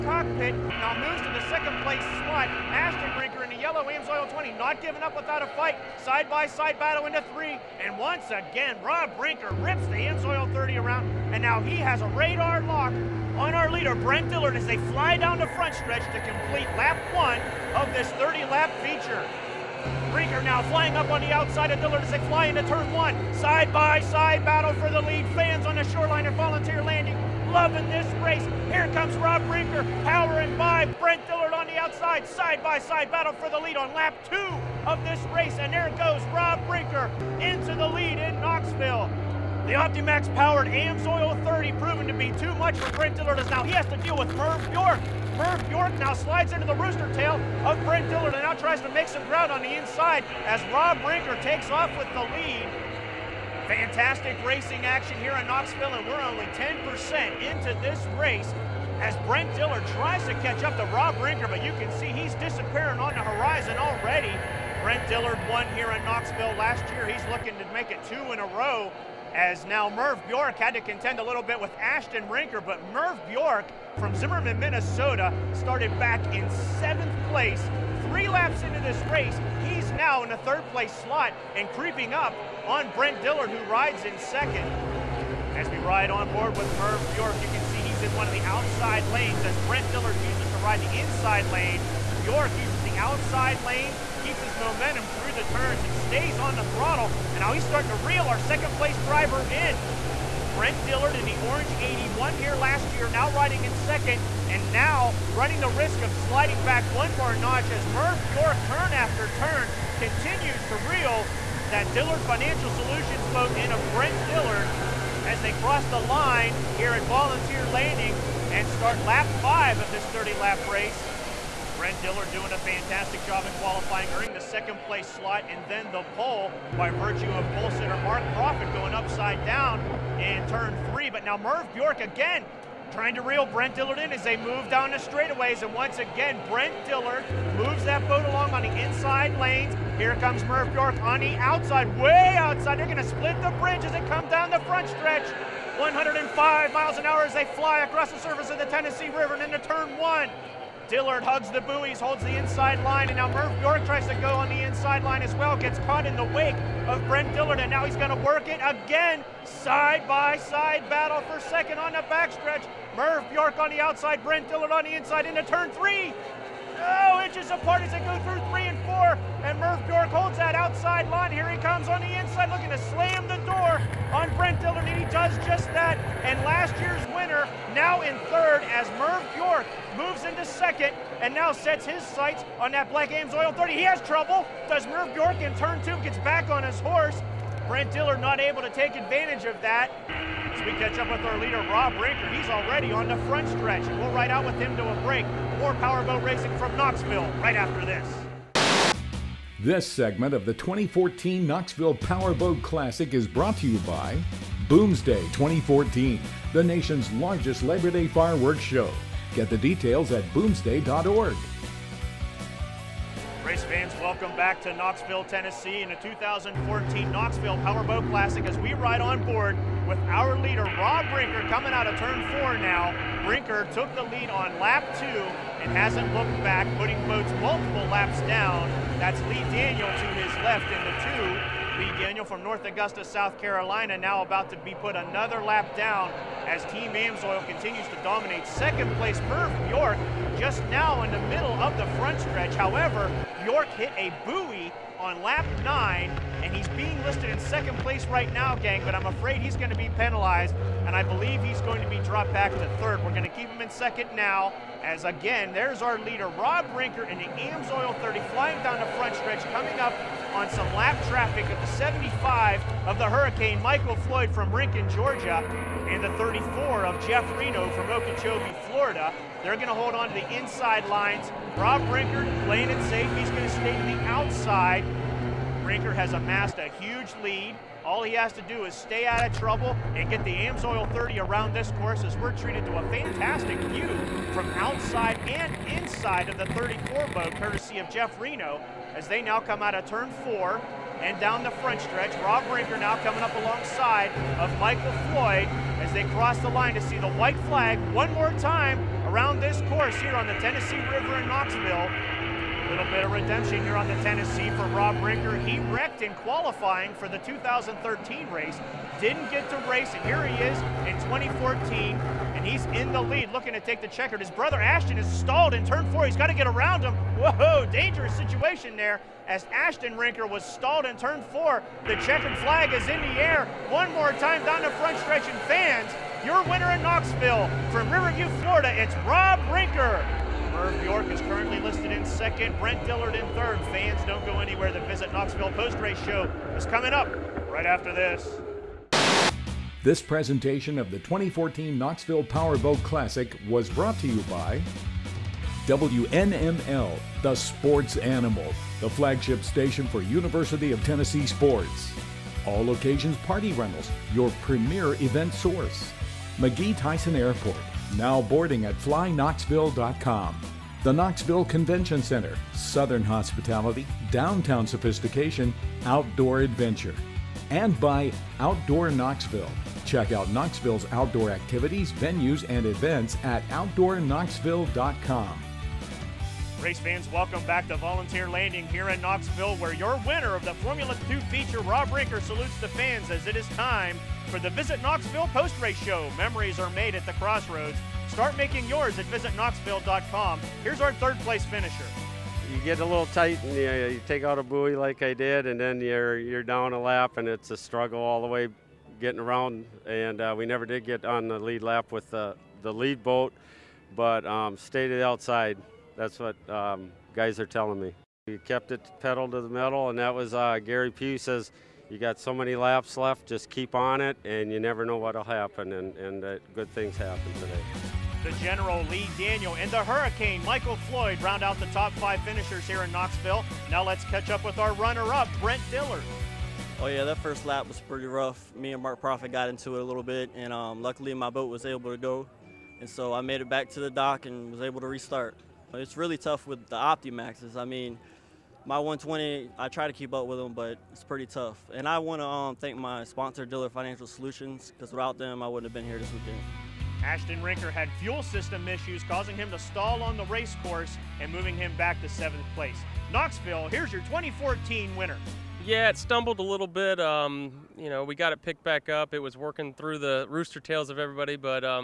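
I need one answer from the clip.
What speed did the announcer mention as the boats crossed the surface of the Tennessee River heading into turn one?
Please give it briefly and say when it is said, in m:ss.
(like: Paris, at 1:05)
105 miles an hour, at 2:25.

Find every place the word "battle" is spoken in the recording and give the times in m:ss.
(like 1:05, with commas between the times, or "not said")
0:06, 0:24, 0:33, 2:40.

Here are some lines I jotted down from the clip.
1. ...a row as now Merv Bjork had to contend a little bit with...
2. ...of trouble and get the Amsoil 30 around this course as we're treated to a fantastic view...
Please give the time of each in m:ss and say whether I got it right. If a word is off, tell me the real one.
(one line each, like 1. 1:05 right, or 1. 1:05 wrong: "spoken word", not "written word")
1. 1:08 right
2. 4:39 right.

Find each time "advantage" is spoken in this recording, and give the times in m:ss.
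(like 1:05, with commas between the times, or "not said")
3:08.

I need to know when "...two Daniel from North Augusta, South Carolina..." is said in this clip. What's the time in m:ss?
3:51.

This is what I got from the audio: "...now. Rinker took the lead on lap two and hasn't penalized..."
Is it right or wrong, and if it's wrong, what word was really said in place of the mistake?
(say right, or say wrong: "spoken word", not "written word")
wrong: "looked", not "penalized".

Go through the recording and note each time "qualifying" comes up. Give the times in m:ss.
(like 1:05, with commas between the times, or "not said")
2:03, 5:06.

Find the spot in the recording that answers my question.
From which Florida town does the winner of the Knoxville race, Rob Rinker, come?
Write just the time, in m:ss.
5:27.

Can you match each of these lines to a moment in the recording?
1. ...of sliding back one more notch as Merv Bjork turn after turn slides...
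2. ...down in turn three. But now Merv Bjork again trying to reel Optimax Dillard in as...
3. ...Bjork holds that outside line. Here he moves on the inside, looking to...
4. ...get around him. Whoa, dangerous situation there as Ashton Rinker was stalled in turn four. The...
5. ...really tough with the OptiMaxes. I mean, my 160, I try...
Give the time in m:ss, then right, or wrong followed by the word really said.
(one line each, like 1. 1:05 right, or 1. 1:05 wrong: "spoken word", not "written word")
1. 1:46 wrong: "continues", not "slides"
2. 2:09 wrong: "Brent", not "Optimax"
3. 2:49 wrong: "comes", not "moves"
4. 5:16 right
5. 7:15 wrong: "120", not "160".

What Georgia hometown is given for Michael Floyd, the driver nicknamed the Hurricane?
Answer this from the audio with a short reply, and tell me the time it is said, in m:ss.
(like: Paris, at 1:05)
Rincon, Georgia, at 4:24.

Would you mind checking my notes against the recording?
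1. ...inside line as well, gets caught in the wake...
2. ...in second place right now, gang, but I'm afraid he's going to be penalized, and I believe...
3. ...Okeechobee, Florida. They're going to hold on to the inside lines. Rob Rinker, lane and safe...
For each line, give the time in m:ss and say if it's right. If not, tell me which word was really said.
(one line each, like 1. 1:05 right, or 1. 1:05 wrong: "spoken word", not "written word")
1. 2:34 right
2. 4:07 right
3. 4:27 right.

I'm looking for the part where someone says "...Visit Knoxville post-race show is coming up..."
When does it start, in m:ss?
5:34.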